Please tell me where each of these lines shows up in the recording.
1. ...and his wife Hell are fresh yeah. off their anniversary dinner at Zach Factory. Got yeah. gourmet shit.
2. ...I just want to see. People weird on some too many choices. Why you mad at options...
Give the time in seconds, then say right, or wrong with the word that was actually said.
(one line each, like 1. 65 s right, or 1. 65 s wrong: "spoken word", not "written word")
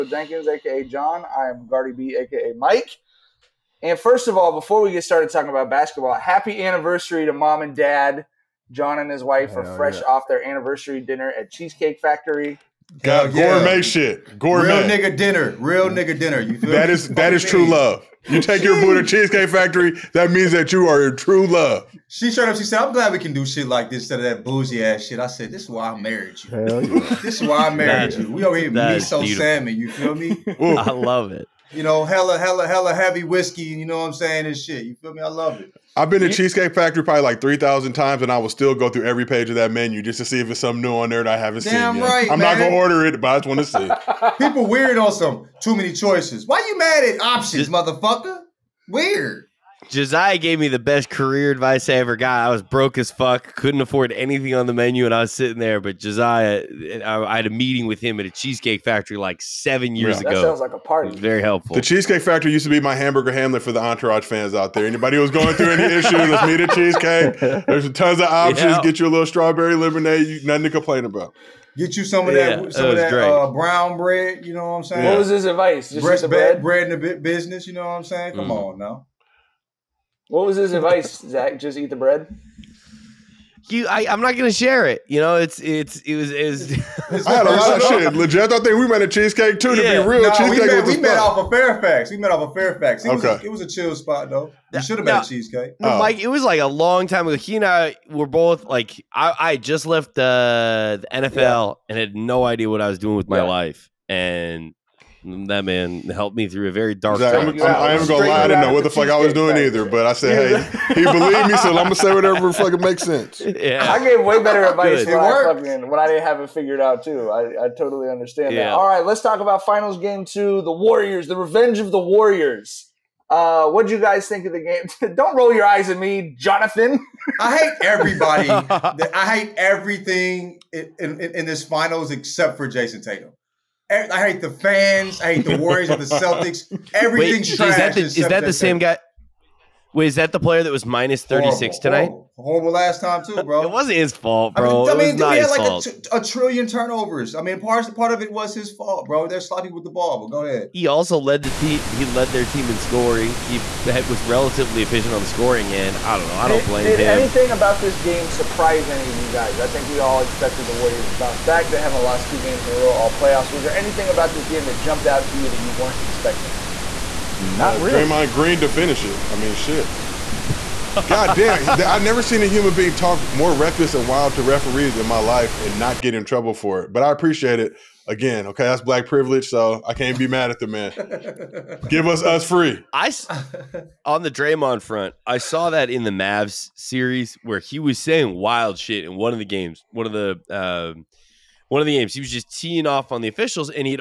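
1. 8 s wrong: "Cheesecake", not "Zach"
2. 43 s right.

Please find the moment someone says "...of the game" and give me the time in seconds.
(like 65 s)
124 s.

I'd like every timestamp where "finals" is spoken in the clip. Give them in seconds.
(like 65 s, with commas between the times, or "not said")
119 s, 131 s.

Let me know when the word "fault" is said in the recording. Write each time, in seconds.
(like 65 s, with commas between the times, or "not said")
144 s, 148 s.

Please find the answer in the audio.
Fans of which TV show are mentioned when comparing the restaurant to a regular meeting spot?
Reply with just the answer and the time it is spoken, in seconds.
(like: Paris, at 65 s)
Entourage, at 63 s.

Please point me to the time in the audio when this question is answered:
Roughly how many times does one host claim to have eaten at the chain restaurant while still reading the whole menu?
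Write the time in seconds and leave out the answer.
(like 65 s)
37 s.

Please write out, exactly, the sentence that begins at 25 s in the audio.
I said, This is why I married you.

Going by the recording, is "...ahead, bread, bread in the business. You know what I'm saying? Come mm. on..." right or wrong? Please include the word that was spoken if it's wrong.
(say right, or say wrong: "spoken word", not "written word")
wrong: "bread", not "ahead".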